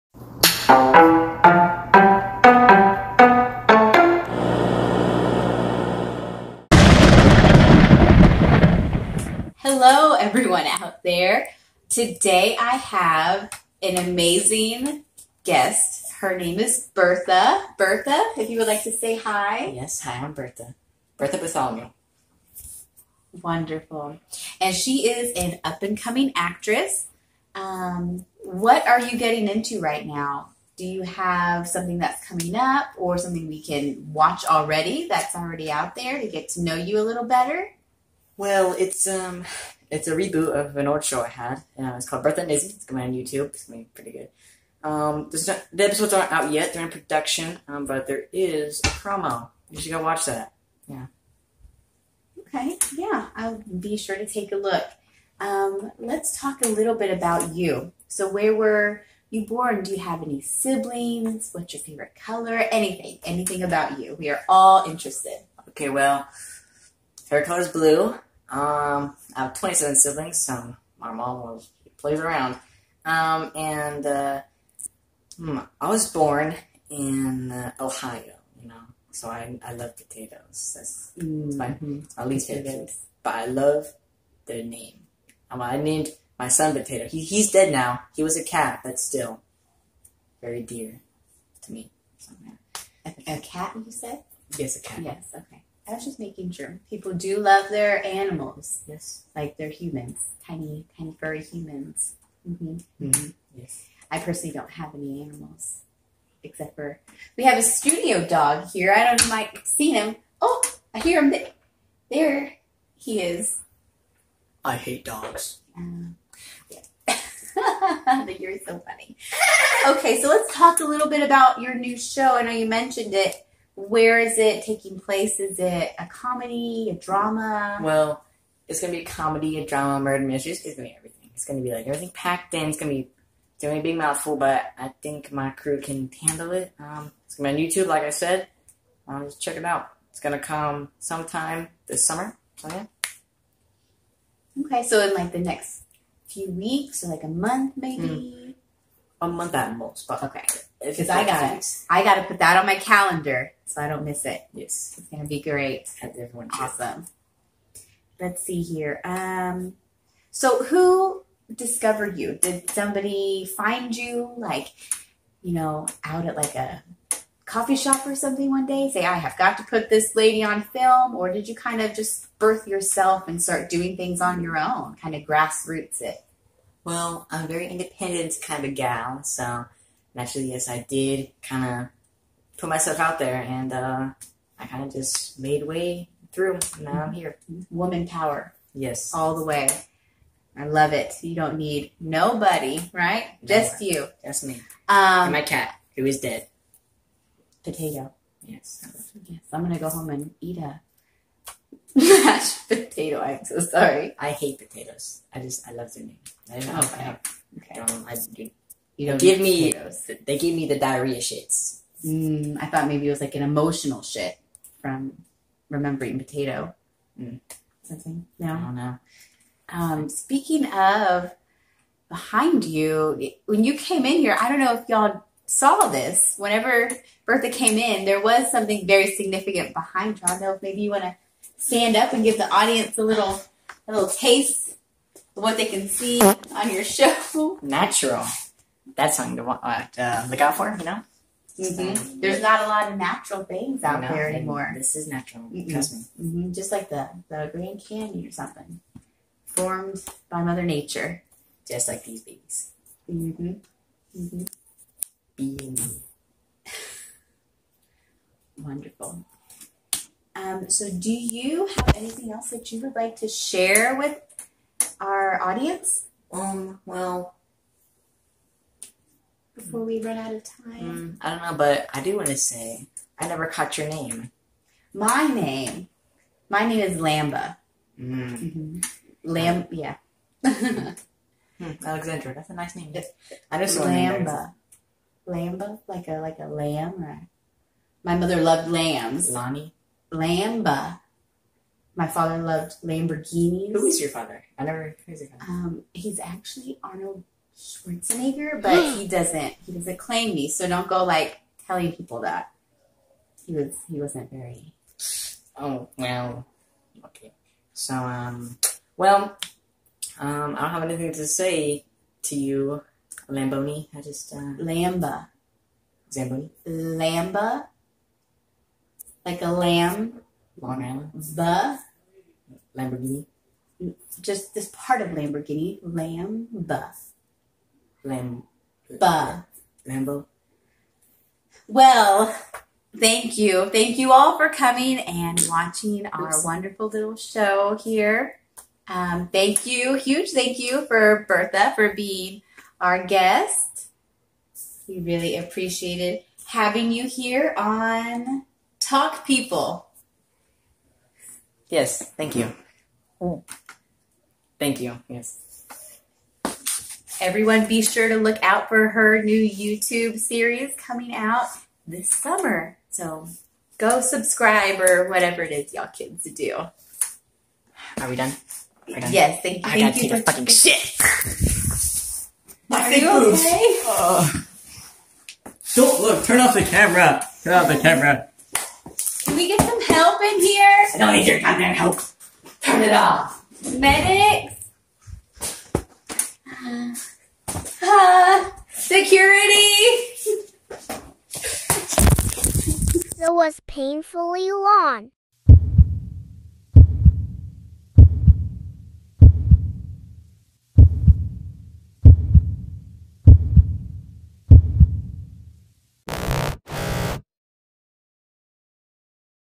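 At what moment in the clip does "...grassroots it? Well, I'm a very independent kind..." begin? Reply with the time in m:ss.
2:55.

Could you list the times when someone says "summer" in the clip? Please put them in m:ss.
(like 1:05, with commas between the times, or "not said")
2:22, 6:02.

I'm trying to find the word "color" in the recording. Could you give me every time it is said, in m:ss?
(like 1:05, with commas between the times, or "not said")
1:02, 1:07.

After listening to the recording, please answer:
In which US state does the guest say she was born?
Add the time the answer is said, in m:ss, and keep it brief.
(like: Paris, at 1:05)
Ohio, at 1:17.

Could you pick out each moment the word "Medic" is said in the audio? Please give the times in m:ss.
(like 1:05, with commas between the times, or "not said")
6:23.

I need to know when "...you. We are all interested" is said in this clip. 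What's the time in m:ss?
1:03.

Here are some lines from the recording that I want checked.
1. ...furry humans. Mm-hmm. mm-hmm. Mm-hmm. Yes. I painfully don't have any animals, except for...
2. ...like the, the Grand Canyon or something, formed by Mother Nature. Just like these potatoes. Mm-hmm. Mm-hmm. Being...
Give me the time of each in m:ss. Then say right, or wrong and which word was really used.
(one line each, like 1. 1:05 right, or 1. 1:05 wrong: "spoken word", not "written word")
1. 1:41 wrong: "personally", not "painfully"
2. 4:06 wrong: "babies", not "potatoes".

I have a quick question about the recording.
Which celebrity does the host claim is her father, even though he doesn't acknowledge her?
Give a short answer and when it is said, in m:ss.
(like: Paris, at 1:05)
Arnold Schwarzenegger, at 4:56.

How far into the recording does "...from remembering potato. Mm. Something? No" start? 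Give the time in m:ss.
3:34.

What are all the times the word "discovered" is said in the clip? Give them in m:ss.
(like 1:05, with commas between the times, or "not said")
2:41.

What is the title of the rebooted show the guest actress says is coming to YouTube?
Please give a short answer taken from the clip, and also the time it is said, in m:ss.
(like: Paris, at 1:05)
Bertha and Izzy, at 0:42.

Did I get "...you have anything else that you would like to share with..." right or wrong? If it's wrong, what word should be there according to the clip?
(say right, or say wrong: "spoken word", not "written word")
right.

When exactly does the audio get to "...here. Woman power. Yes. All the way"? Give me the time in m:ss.
3:07.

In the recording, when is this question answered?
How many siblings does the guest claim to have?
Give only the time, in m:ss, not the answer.
1:09.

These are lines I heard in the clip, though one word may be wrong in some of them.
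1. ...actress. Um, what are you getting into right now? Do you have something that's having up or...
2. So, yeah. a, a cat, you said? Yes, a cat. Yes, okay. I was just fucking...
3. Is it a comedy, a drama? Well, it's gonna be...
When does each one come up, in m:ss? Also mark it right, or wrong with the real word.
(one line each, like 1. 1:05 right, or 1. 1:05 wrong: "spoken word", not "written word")
1. 0:26 wrong: "coming", not "having"
2. 1:32 wrong: "making", not "fucking"
3. 2:05 right.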